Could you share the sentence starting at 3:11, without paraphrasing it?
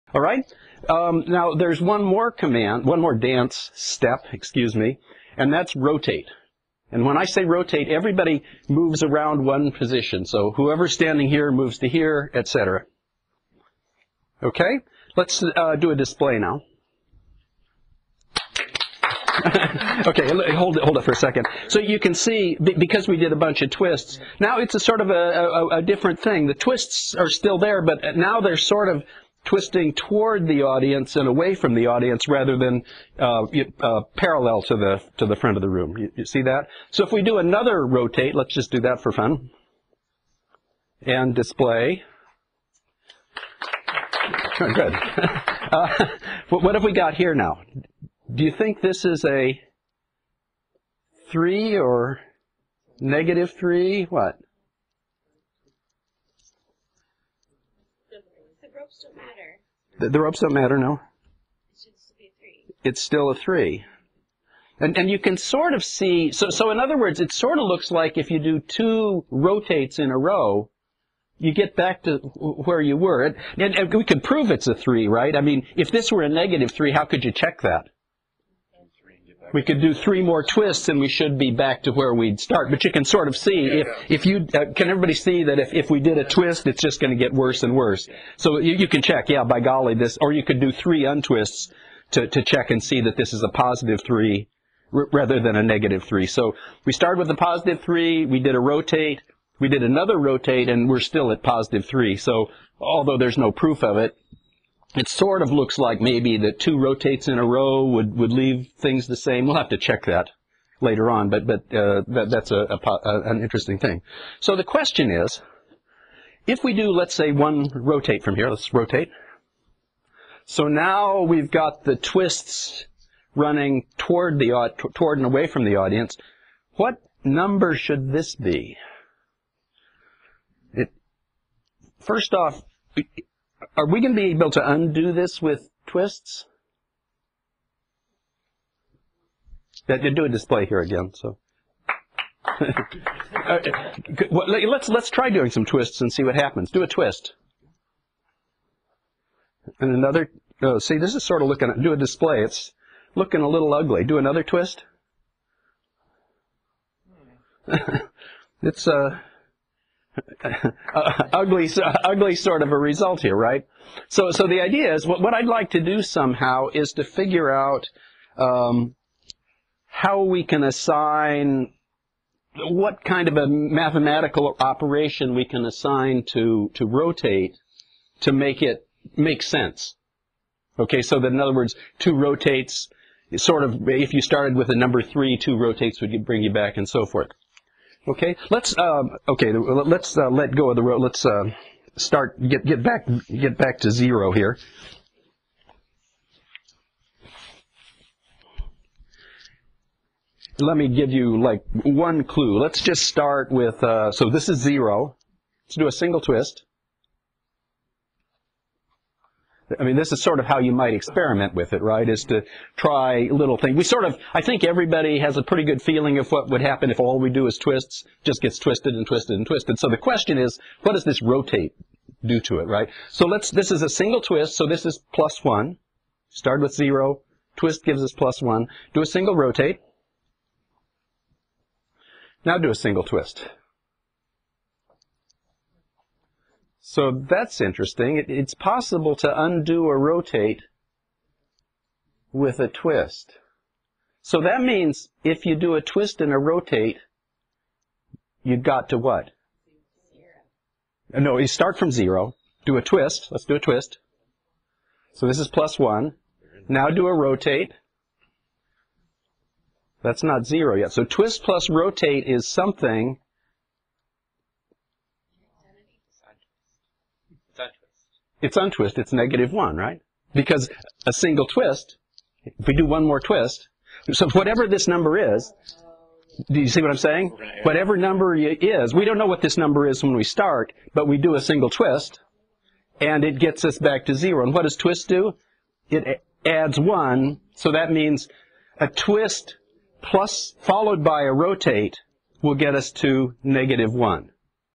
Let's uh, start get get back get back to zero here.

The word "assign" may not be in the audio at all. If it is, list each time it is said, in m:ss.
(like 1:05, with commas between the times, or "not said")
2:50, 2:55.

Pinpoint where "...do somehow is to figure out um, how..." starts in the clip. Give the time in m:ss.
2:45.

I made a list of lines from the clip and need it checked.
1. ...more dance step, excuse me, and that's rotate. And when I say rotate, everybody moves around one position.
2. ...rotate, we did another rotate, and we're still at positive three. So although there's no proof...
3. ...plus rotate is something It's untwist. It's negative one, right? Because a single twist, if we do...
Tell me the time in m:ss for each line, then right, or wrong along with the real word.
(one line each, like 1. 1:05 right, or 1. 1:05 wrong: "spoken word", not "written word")
1. 0:02 right
2. 1:38 right
3. 4:21 right.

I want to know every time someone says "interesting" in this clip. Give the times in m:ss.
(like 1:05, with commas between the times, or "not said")
1:53, 3:57.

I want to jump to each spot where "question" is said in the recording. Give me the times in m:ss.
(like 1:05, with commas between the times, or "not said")
1:54, 3:39.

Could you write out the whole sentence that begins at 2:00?
So now we've got the twists running toward the toward and away from the audience.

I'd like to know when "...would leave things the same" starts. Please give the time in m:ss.
1:48.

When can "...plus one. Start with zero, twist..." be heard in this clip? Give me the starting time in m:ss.
3:45.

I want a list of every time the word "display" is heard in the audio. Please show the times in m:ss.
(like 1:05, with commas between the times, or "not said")
0:15, 0:41, 2:20, 2:31.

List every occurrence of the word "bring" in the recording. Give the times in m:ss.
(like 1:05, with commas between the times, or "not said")
3:06.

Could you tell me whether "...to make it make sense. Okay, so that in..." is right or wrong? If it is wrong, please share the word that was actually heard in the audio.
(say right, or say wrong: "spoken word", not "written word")
right.